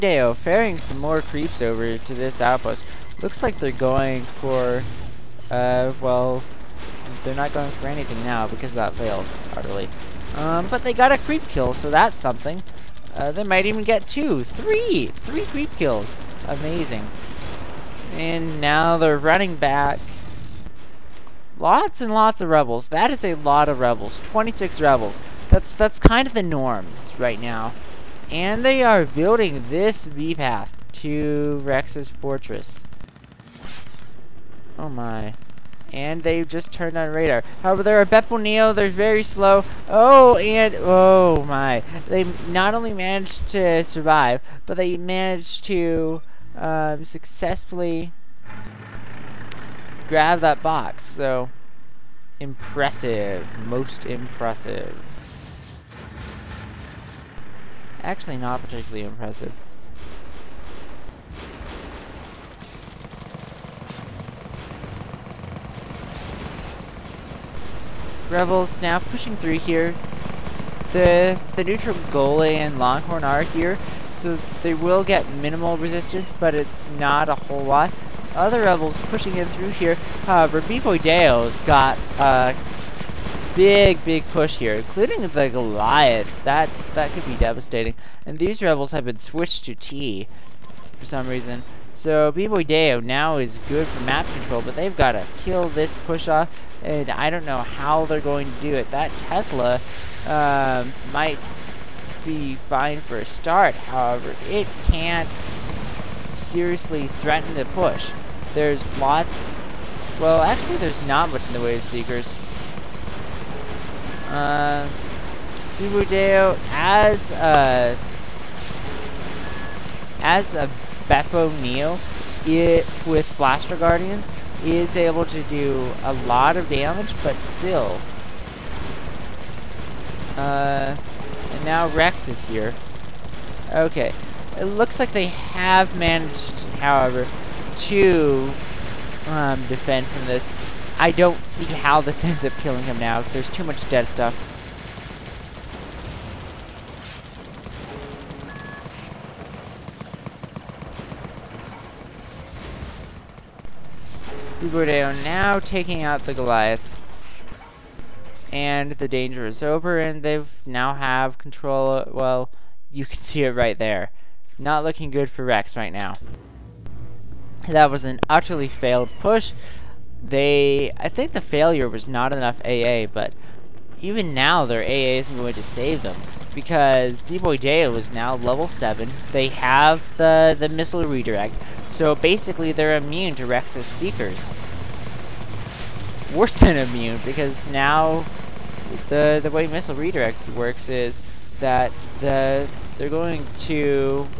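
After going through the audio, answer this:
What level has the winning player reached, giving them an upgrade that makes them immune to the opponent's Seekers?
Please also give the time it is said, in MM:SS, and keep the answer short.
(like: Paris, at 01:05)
7, at 02:58.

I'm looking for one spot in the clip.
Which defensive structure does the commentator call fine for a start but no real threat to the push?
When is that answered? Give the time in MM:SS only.
01:39.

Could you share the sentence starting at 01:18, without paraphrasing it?
Other Rebels pushing in through here.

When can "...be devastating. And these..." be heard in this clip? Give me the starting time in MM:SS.
01:27.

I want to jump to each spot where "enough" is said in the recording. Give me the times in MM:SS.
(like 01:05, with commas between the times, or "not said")
02:52.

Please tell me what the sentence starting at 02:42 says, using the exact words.
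Well, you can see it right there.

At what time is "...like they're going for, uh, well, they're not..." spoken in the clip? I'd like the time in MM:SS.
00:03.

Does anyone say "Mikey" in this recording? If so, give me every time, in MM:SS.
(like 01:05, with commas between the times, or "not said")
not said.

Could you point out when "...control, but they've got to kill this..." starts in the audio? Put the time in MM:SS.
01:34.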